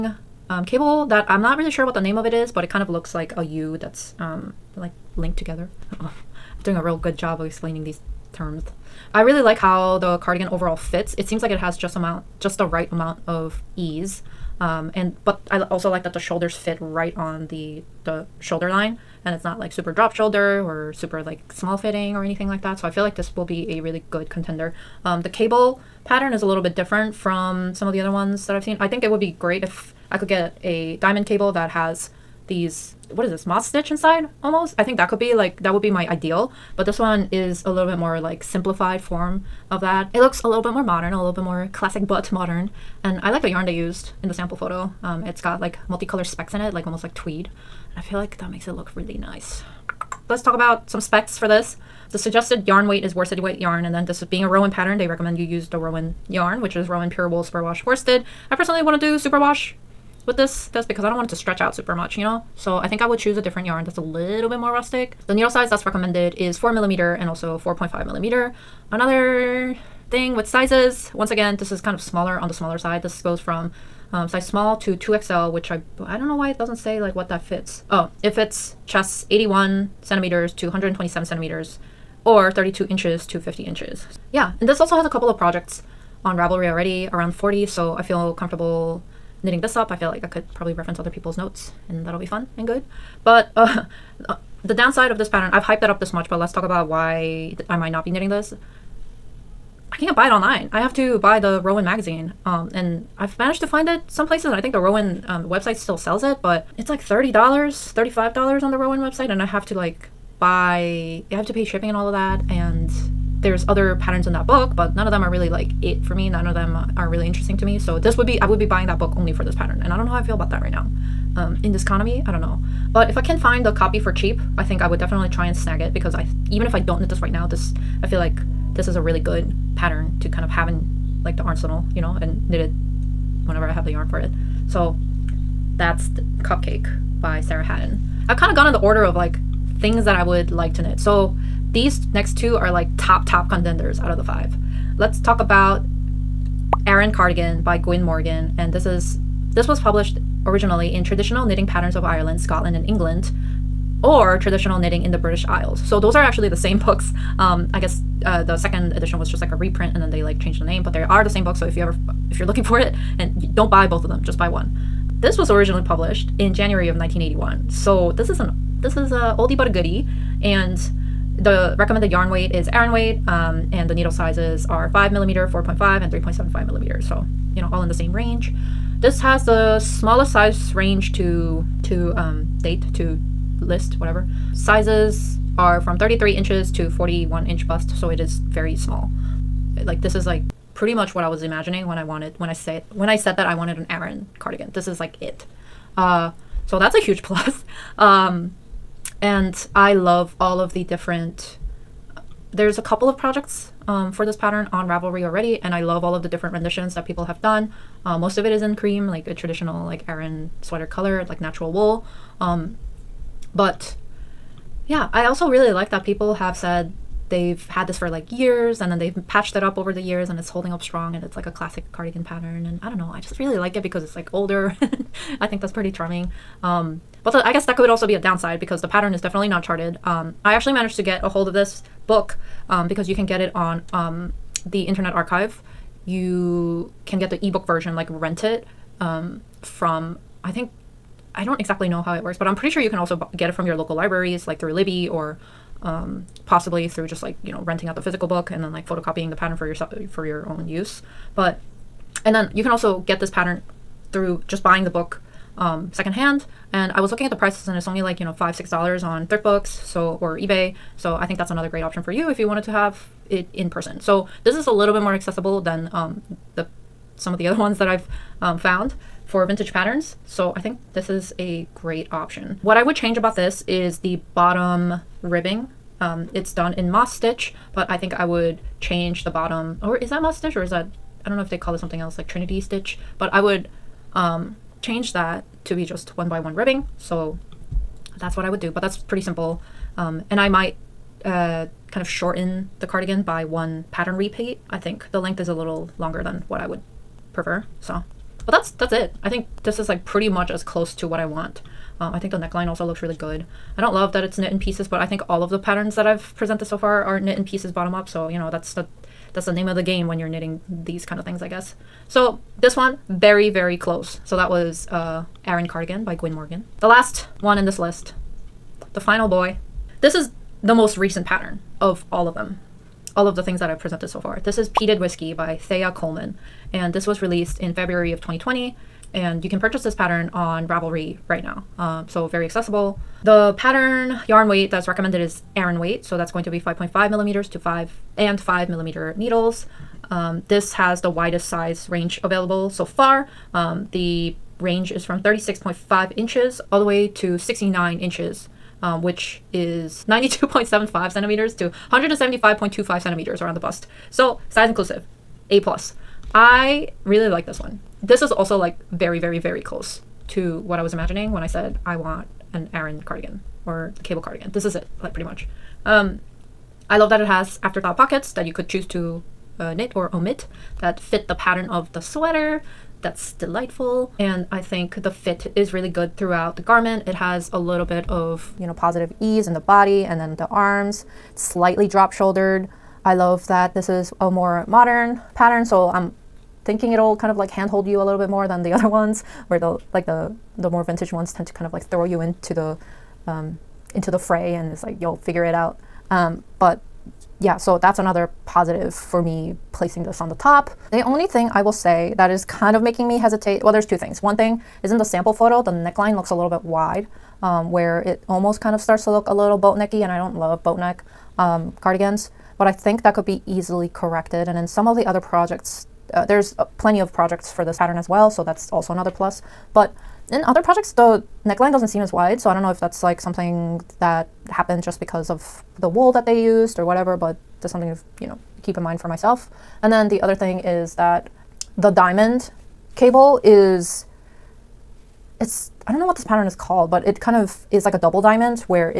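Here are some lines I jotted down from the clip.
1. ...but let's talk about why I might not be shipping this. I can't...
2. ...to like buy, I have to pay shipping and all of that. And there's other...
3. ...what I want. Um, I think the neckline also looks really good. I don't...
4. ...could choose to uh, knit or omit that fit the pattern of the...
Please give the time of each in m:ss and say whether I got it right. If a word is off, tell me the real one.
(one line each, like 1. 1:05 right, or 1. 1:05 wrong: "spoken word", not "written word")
1. 1:36 wrong: "knitting", not "shipping"
2. 1:49 right
3. 5:01 right
4. 6:08 right.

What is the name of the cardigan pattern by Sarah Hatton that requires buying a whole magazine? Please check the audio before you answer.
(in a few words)
Cupcake.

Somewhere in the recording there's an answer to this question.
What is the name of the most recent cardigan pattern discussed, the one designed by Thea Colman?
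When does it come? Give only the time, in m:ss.
5:24.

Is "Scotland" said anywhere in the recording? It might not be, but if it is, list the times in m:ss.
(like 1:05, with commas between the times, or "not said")
2:32.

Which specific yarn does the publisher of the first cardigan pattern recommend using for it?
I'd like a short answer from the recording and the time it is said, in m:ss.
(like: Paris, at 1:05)
Rowan Pure Wool Superwash Worsted, at 0:56.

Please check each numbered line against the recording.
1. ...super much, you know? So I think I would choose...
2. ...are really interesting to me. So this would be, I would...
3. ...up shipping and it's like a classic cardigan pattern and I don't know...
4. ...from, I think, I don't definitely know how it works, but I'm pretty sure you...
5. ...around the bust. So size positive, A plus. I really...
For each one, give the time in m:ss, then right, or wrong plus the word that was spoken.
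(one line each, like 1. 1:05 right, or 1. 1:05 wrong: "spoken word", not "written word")
1. 1:01 right
2. 1:56 right
3. 3:40 wrong: "strong", not "shipping"
4. 3:59 wrong: "exactly", not "definitely"
5. 5:53 wrong: "inclusive", not "positive".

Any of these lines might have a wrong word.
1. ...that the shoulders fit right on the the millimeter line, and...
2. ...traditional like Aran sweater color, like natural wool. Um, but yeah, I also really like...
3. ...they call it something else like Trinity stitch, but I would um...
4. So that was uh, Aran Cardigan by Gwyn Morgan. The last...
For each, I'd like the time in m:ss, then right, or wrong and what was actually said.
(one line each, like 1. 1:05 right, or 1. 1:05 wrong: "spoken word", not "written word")
1. 0:16 wrong: "shoulder", not "millimeter"
2. 3:29 right
3. 4:41 right
4. 5:14 right.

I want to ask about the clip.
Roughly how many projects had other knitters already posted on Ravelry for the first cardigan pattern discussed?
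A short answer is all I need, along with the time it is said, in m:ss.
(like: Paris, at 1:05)
around 40, at 1:27.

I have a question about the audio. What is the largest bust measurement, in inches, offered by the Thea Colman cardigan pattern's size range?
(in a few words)
69 inches.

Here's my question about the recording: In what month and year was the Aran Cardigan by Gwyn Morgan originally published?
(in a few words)
January 1981.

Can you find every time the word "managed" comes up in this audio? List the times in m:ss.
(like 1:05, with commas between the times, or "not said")
1:43, 3:50.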